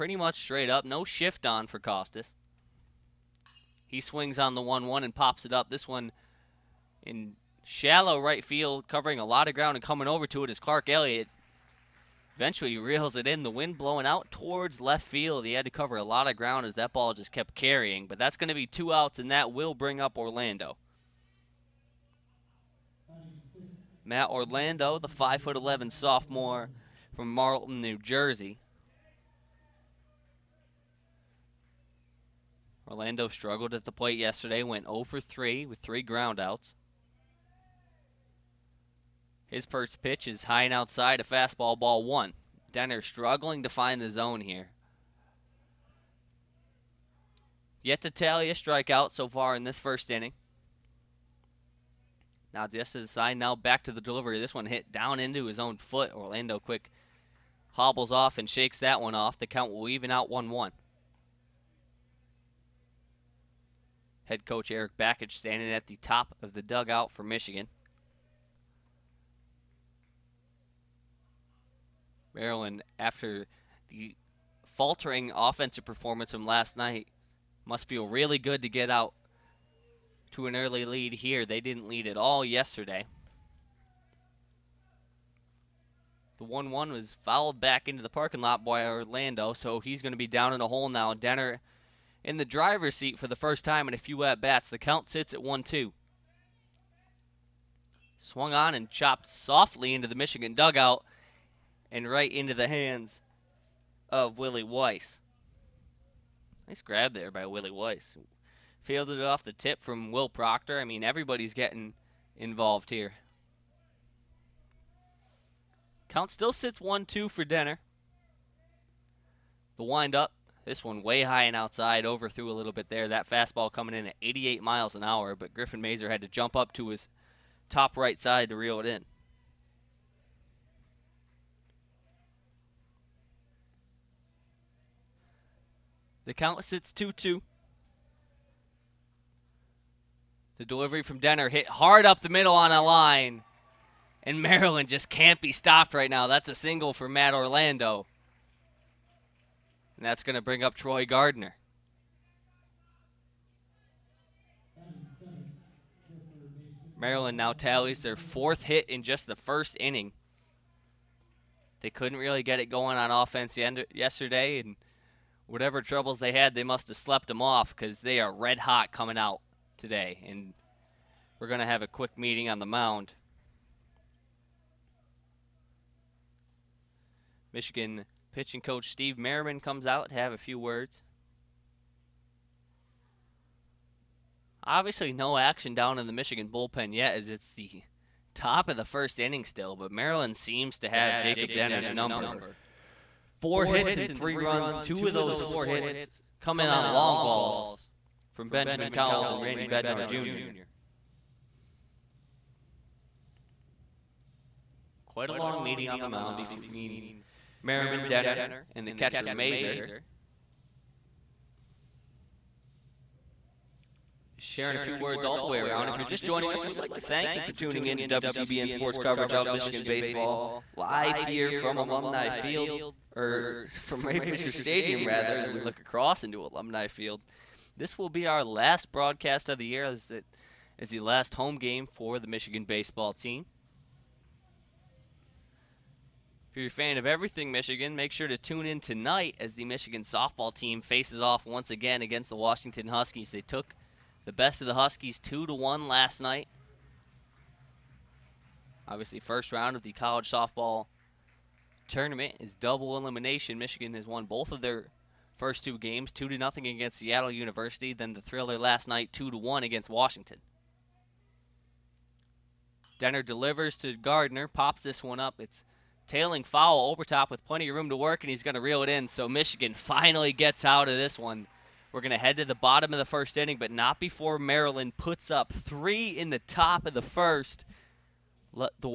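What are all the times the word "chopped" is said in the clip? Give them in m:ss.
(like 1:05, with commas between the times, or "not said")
1:38.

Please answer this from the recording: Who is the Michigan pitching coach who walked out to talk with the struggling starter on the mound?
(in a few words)
Steve Merriman.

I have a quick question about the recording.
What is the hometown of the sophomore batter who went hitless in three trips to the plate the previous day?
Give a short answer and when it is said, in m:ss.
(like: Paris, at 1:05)
Marlton, New Jersey, at 0:27.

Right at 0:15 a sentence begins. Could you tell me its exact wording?
He had to cover a lot of ground as that ball just kept carrying.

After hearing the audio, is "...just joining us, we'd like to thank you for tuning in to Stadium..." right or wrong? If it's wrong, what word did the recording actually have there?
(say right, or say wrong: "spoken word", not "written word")
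wrong: "WCBN", not "Stadium".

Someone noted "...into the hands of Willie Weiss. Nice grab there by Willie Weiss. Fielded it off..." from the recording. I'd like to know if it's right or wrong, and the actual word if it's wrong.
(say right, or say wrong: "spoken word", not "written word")
right.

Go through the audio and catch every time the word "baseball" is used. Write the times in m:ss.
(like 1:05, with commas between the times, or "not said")
3:39, 3:52.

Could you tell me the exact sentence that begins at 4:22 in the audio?
Denner delivers to Gardner, pops this one up.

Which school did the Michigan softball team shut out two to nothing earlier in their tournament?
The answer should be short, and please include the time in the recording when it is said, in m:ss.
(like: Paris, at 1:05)
Seattle University, at 4:16.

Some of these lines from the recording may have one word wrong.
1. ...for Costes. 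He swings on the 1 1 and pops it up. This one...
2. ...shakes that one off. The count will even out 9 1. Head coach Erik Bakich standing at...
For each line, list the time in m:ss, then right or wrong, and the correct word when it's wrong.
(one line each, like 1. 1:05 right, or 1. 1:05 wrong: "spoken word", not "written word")
1. 0:01 right
2. 0:58 wrong: "1", not "9".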